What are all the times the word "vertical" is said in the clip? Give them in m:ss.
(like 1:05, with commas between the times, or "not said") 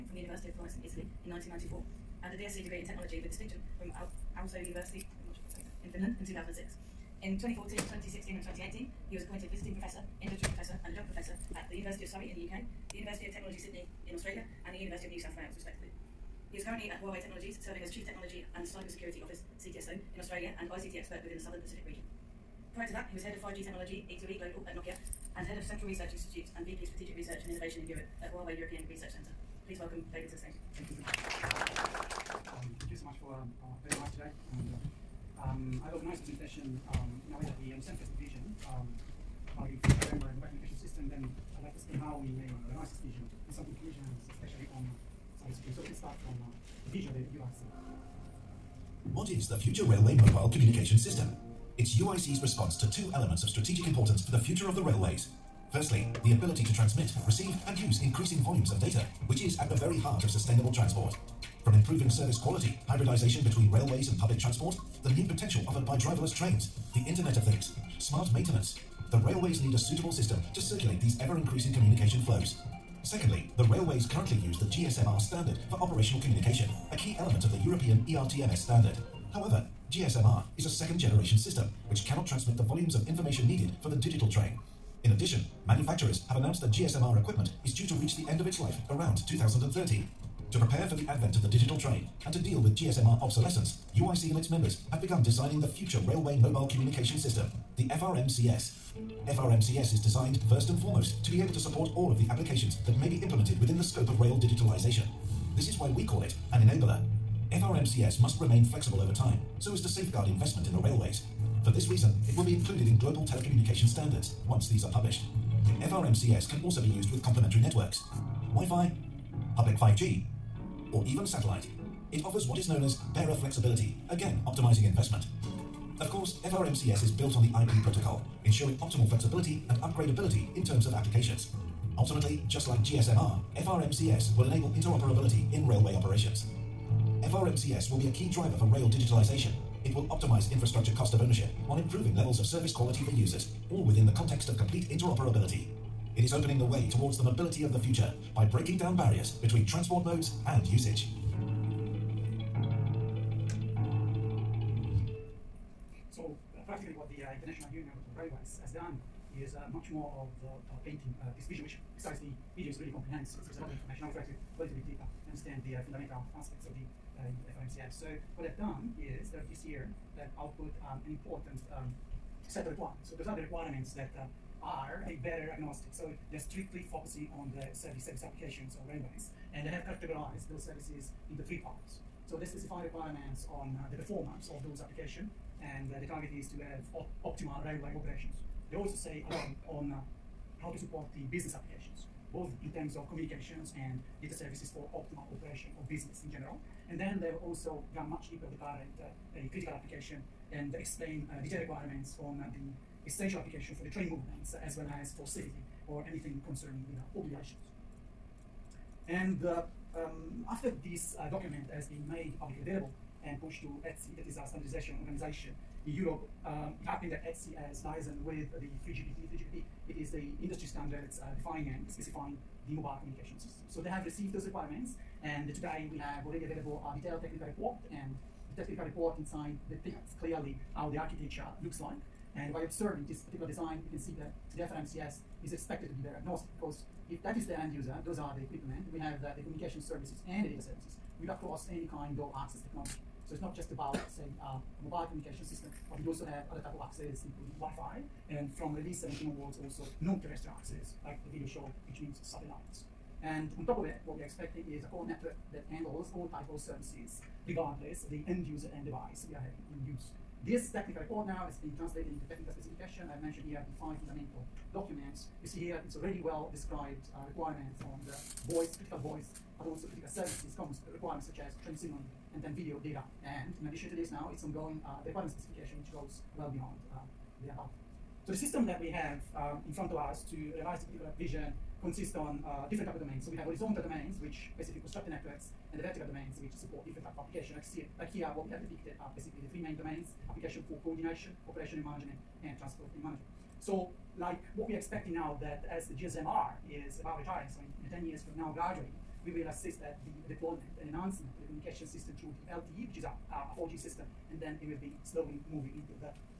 4:45.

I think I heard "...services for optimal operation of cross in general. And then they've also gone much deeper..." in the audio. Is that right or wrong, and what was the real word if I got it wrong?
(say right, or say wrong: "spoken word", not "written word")
wrong: "business", not "cross".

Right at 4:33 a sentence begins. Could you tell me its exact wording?
And in addition to this, now it's ongoing uh, the requirement specification, which goes well beyond uh, the above.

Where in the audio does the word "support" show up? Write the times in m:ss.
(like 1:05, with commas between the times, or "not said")
1:41, 3:10, 4:46.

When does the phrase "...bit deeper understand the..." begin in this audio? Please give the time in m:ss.
2:44.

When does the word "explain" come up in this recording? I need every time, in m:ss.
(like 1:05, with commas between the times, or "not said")
0:41, 3:20.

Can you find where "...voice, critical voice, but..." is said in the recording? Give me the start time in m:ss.
4:28.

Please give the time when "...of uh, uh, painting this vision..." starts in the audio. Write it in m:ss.
2:40.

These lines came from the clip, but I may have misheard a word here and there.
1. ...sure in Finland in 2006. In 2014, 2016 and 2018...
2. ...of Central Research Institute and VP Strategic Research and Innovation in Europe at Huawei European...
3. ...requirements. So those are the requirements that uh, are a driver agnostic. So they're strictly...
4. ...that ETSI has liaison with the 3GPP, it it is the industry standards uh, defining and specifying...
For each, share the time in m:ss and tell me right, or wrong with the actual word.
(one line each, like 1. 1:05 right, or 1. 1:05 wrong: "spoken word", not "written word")
1. 0:05 right
2. 0:25 right
3. 2:52 wrong: "bearer", not "driver"
4. 3:37 right.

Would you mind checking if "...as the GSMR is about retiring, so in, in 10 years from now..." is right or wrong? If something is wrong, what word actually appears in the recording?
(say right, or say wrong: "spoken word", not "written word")
right.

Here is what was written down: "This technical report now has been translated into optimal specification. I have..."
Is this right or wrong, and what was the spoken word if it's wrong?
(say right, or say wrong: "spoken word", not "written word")
wrong: "technical", not "optimal".